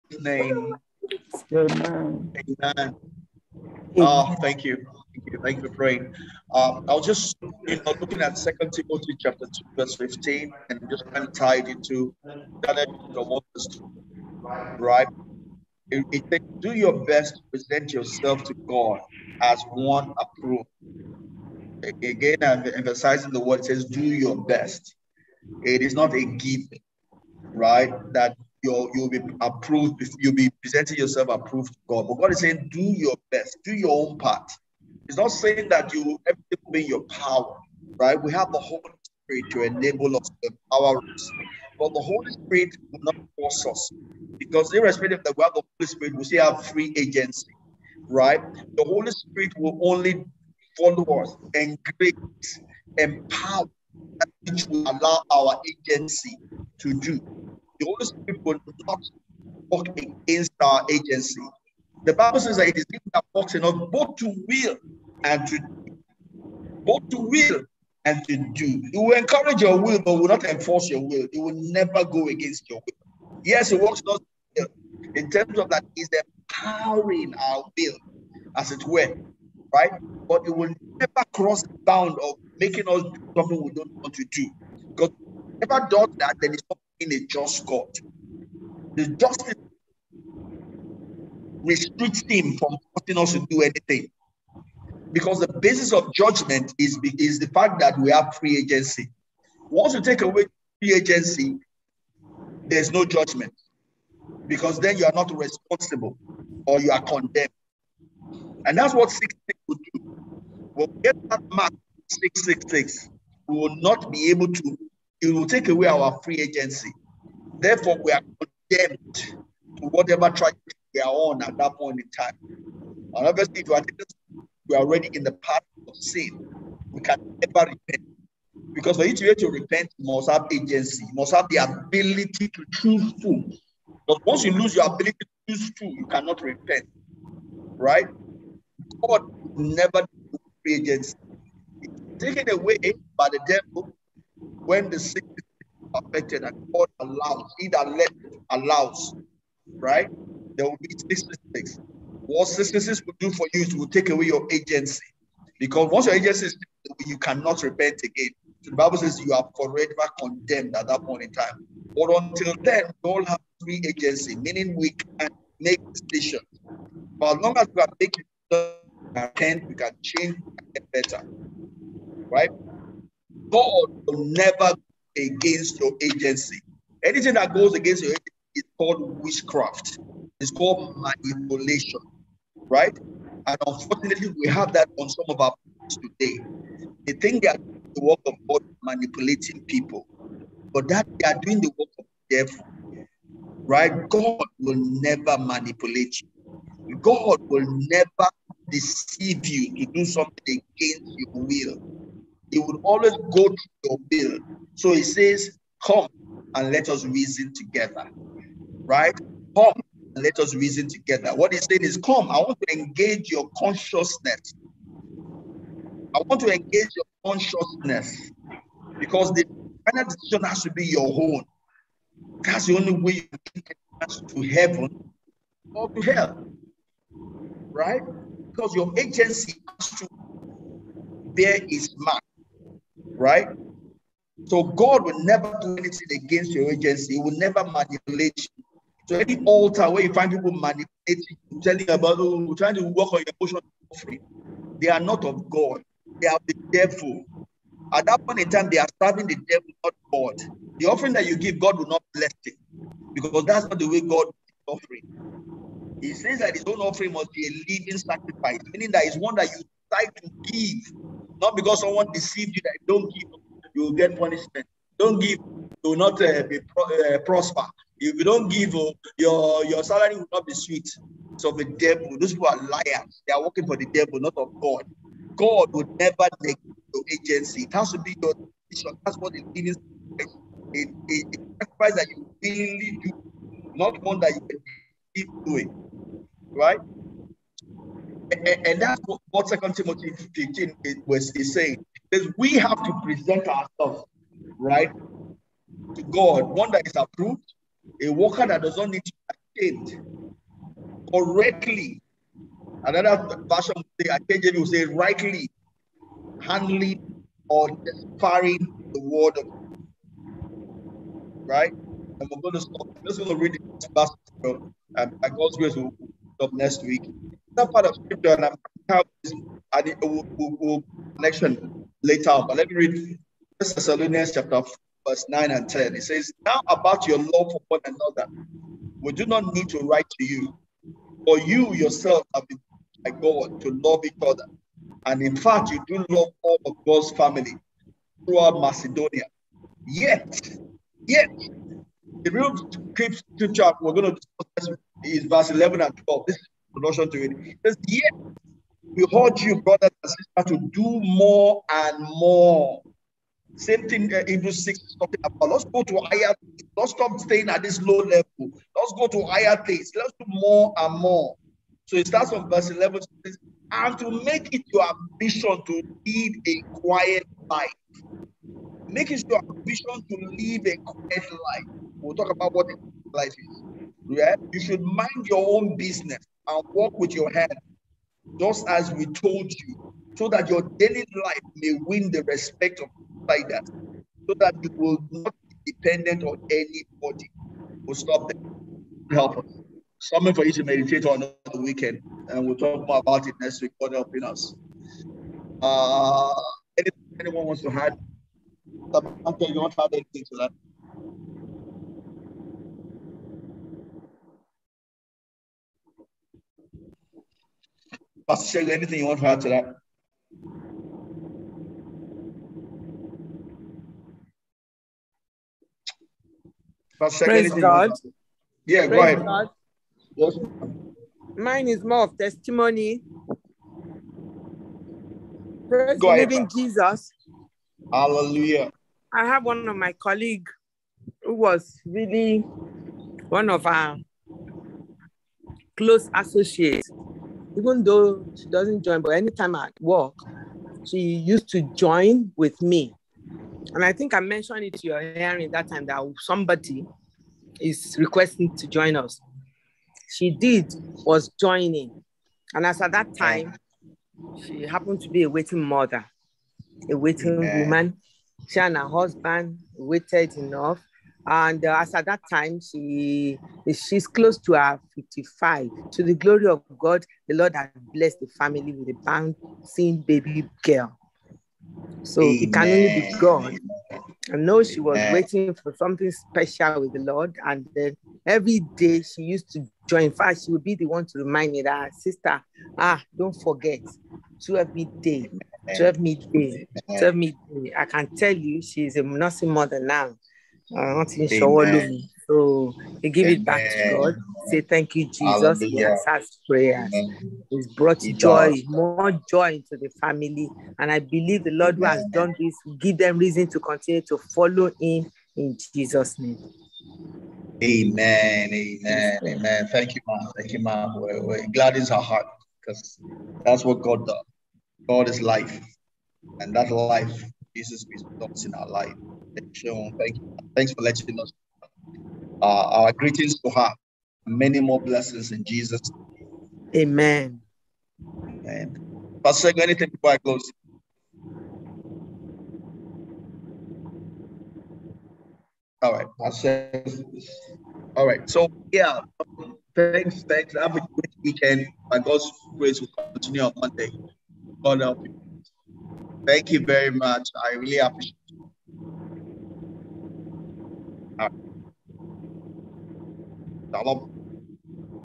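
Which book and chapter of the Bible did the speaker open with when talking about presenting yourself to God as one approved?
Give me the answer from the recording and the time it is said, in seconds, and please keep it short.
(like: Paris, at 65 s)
Second Timothy chapter 2, at 8 s.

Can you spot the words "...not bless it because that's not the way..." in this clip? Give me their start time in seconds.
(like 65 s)
251 s.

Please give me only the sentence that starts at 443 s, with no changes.
And I think I mentioned it to your hearing that time that somebody is requesting to join us.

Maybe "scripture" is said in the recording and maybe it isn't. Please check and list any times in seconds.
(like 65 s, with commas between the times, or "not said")
317 s, 342 s.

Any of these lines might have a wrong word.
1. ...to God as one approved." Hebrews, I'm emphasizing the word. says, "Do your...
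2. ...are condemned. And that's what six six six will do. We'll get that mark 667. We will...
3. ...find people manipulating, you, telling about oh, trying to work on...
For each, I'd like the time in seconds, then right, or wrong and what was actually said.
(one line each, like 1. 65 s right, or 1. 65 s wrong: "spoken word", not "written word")
1. 18 s wrong: "Again", not "Hebrews"
2. 106 s wrong: "666", not "667"
3. 240 s right.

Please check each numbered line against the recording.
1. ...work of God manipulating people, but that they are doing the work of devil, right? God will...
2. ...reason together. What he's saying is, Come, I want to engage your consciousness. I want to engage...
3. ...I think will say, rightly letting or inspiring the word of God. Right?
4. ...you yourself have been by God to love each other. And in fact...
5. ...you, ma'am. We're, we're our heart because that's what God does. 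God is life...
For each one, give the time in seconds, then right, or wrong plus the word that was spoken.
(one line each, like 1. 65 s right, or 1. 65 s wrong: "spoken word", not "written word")
1. 188 s right
2. 210 s right
3. 304 s wrong: "handling", not "letting"
4. 331 s right
5. 510 s right.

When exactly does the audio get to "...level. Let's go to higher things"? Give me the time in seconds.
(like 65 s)
357 s.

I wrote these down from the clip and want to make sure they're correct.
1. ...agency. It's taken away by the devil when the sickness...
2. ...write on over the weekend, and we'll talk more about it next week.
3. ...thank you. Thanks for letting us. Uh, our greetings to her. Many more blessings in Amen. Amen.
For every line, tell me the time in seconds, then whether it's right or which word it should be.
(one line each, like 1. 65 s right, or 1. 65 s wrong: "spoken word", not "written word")
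1. 140 s right
2. 390 s wrong: "meditate", not "write"
3. 519 s wrong: "Jesus", not "Amen".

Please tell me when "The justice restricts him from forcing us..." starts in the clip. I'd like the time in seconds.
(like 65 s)
88 s.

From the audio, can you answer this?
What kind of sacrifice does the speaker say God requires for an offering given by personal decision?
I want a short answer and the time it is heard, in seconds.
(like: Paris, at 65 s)
A living sacrifice, at 257 s.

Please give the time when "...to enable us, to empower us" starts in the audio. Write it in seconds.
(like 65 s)
39 s.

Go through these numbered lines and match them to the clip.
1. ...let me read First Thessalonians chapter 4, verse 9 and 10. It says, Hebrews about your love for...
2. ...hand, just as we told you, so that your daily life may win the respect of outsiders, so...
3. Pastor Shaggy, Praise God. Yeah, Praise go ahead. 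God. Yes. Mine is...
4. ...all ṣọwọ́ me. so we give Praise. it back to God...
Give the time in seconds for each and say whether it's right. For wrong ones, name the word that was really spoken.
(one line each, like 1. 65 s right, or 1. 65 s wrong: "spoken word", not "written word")
1. 322 s wrong: "Now", not "Hebrews"
2. 377 s right
3. 416 s right
4. 491 s wrong: "Amen", not "Praise".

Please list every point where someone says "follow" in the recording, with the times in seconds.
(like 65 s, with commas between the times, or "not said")
50 s, 504 s.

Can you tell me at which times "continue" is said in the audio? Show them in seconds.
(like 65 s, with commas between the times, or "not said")
503 s, 543 s.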